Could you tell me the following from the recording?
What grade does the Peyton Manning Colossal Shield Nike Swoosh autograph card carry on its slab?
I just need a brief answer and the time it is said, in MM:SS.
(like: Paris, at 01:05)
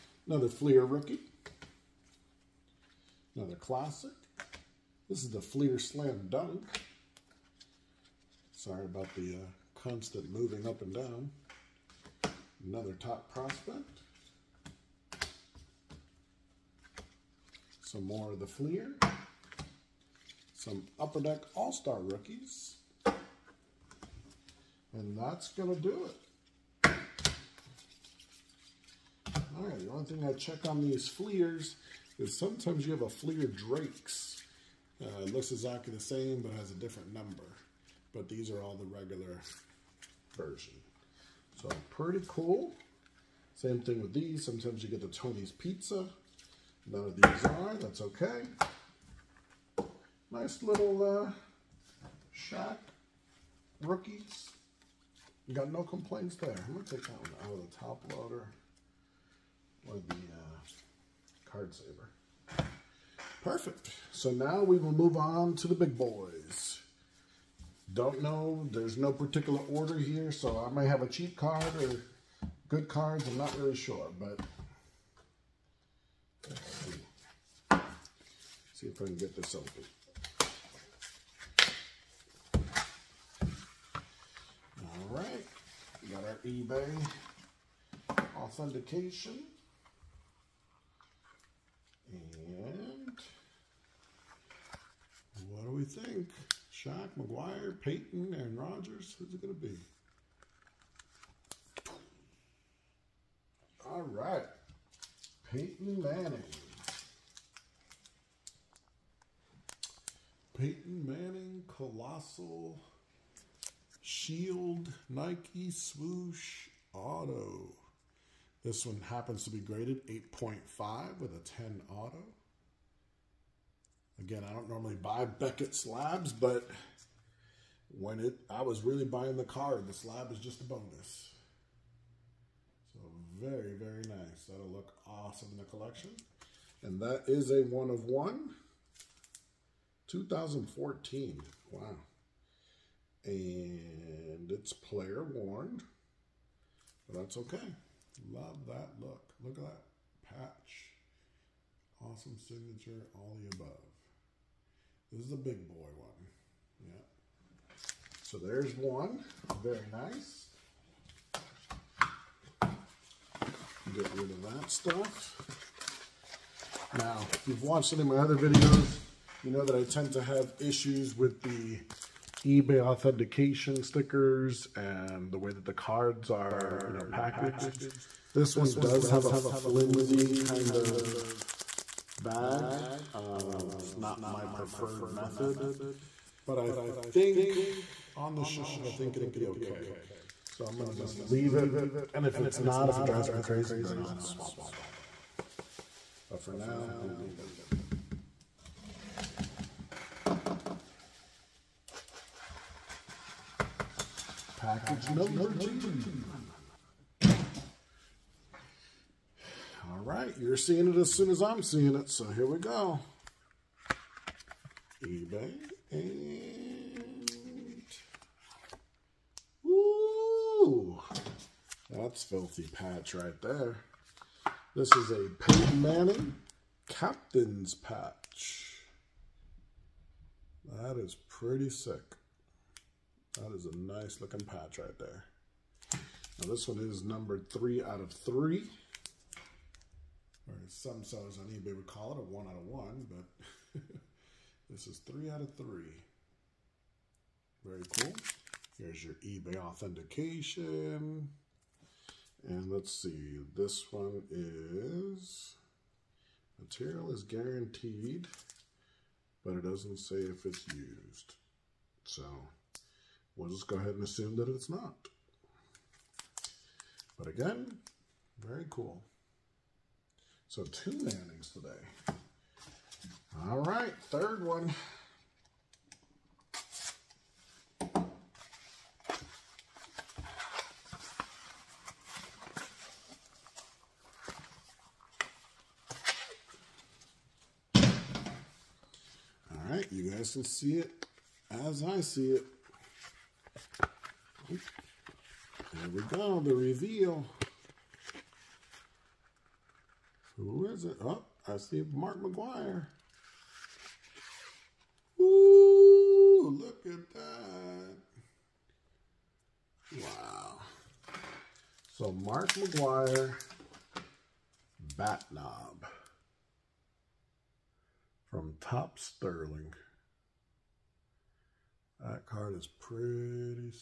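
8.5, at 02:00.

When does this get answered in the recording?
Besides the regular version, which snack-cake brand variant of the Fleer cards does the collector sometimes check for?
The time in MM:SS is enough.
00:33.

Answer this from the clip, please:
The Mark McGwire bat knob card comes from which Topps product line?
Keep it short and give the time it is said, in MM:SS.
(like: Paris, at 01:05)
Topps Sterling, at 05:18.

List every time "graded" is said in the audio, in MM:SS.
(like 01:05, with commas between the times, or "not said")
01:59.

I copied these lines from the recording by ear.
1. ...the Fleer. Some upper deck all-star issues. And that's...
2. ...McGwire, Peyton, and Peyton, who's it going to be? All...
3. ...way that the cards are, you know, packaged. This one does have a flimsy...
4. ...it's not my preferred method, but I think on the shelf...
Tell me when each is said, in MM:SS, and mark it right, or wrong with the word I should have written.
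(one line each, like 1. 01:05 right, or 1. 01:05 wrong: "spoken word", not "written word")
1. 00:18 wrong: "rookies", not "issues"
2. 01:37 wrong: "Rogers", not "Peyton"
3. 02:55 right
4. 03:03 right.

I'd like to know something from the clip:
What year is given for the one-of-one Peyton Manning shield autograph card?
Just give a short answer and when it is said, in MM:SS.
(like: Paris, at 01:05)
2014, at 02:20.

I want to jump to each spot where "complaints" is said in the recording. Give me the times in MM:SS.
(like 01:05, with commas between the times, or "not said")
00:55.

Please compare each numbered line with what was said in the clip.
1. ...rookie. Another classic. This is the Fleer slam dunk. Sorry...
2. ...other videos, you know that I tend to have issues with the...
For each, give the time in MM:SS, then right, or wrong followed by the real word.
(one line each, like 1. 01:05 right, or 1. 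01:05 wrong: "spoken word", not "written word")
1. 00:00 right
2. 02:48 right.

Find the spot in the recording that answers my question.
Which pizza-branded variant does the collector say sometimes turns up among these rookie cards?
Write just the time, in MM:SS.
00:45.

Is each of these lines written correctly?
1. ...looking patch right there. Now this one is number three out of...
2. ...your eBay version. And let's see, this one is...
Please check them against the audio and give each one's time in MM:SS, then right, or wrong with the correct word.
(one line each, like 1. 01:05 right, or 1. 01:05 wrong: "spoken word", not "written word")
1. 03:54 right
2. 04:09 wrong: "authentication", not "version".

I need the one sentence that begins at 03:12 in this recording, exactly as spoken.
And if it's not, if it drives me crazy, then I'll swap it out.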